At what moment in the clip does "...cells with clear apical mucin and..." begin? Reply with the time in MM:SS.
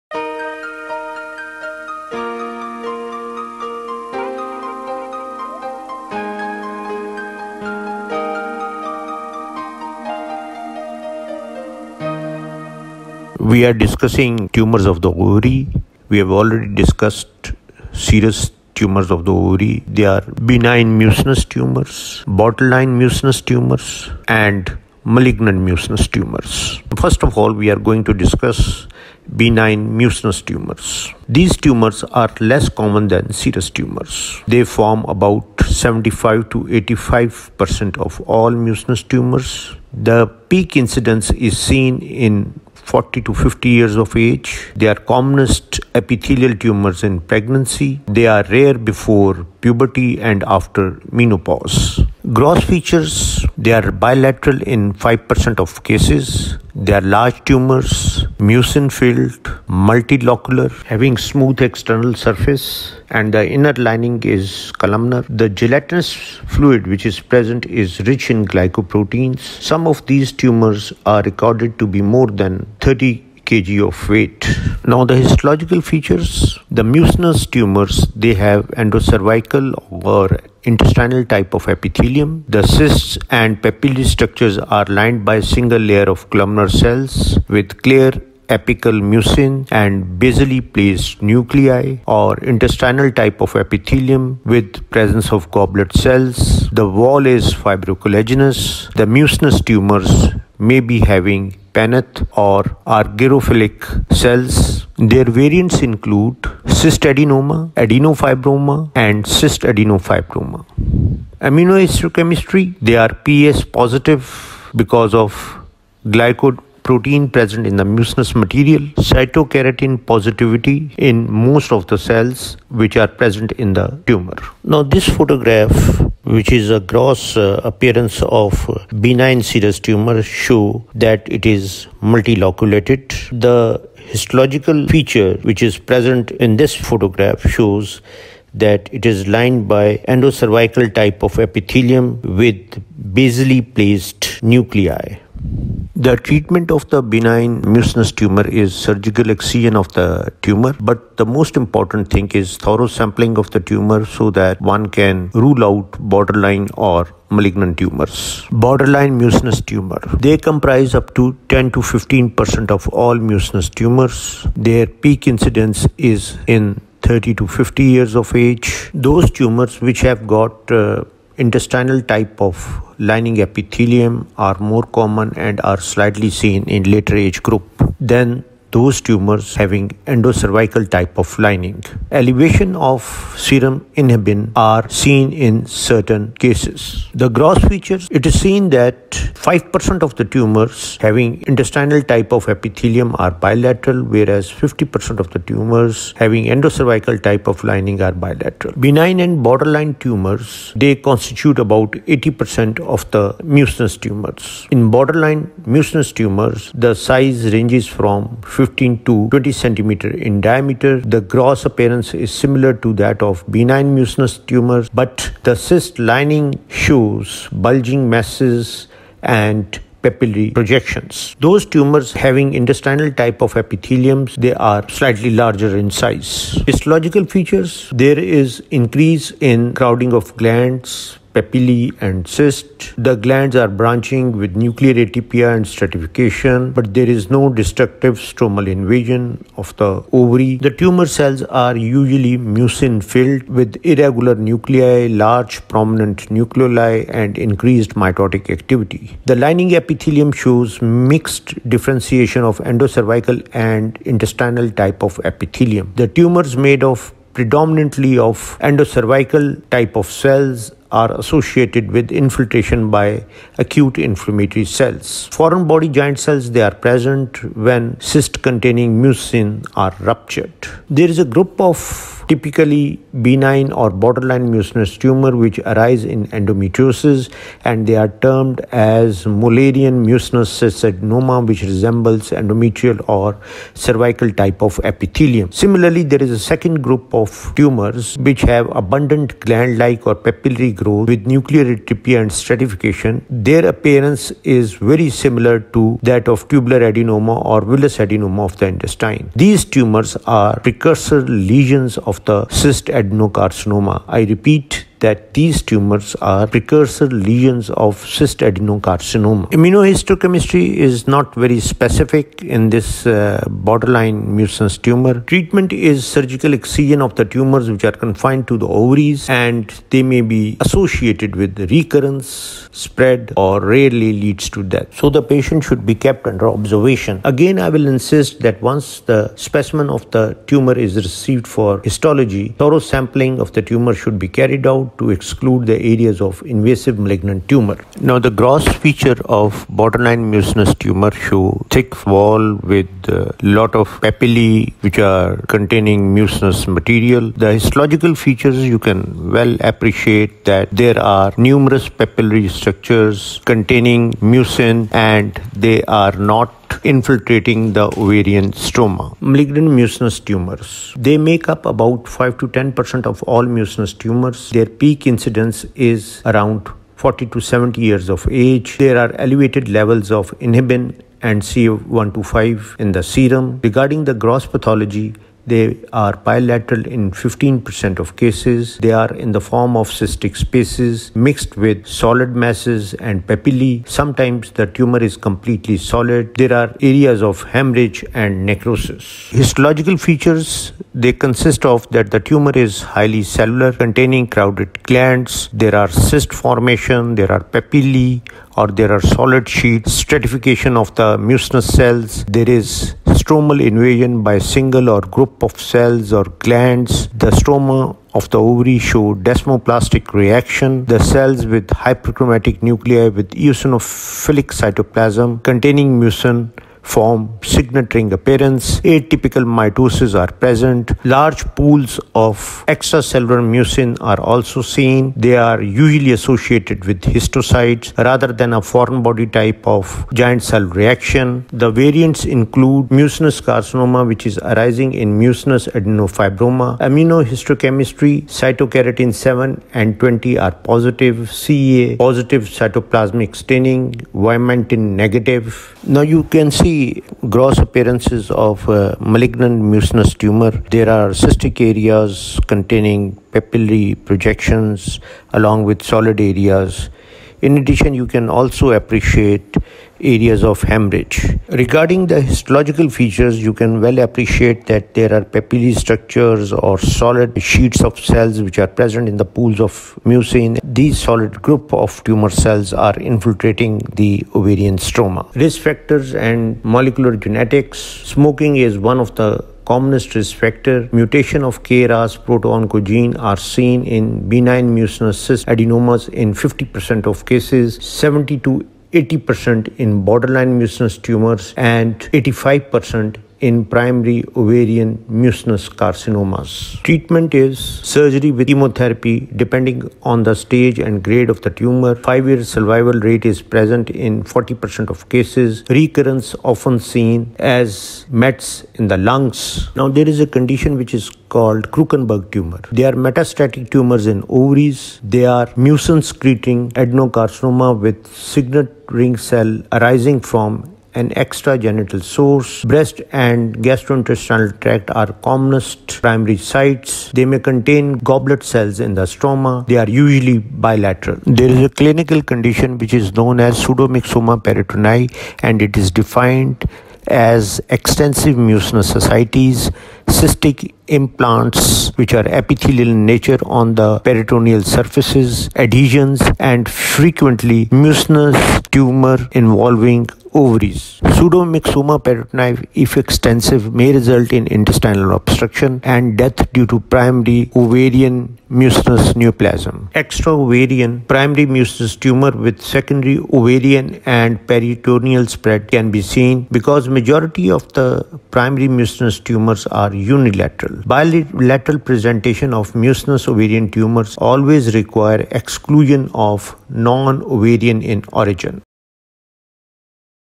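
01:26.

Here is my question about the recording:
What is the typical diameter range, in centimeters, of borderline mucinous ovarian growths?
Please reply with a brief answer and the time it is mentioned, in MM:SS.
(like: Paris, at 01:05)
15 to 20 cm, at 03:28.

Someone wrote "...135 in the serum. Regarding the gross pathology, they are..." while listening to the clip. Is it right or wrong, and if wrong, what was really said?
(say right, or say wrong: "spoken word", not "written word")
wrong: "125", not "135".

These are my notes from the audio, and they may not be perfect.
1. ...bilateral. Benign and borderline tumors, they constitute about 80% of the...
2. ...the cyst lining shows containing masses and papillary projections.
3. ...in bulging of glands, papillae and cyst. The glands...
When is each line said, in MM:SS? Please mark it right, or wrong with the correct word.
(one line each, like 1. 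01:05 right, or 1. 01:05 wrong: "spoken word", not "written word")
1. 03:18 right
2. 03:35 wrong: "bulging", not "containing"
3. 03:49 wrong: "crowding", not "bulging".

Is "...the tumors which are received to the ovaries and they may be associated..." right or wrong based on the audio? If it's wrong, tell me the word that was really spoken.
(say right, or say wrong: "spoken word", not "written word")
wrong: "confined", not "received".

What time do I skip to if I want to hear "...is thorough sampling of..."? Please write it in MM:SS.
02:32.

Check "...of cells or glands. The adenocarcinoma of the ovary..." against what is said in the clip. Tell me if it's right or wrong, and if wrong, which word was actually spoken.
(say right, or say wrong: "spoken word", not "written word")
wrong: "stroma", not "adenocarcinoma".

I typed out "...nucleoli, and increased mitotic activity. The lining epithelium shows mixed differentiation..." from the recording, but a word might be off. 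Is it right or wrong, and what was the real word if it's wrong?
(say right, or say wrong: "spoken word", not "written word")
right.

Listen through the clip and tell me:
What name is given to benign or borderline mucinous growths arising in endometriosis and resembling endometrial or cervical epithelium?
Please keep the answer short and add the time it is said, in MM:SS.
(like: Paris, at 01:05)
mullerian mucinous adenoma, at 04:39.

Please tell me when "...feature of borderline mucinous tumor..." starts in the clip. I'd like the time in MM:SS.
05:38.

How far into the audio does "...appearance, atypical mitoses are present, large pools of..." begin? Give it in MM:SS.
06:58.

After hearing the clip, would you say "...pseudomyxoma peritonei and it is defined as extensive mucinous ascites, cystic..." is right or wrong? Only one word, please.
right.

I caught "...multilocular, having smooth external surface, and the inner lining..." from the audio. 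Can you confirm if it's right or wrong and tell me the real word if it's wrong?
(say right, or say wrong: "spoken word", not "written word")
right.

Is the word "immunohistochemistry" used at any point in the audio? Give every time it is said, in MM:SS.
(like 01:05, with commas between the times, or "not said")
01:51, 05:09, 07:16.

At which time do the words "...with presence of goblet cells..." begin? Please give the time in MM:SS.
01:34.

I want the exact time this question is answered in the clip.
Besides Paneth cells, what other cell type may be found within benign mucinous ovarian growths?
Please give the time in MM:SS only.
01:42.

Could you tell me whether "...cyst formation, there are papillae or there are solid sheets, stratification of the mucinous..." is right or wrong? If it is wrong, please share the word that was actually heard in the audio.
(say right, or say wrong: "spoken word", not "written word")
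right.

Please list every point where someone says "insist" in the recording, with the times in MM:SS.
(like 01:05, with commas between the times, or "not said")
05:27.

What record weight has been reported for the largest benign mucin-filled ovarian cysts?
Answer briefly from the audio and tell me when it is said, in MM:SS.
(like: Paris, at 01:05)
more than 30 kg, at 01:12.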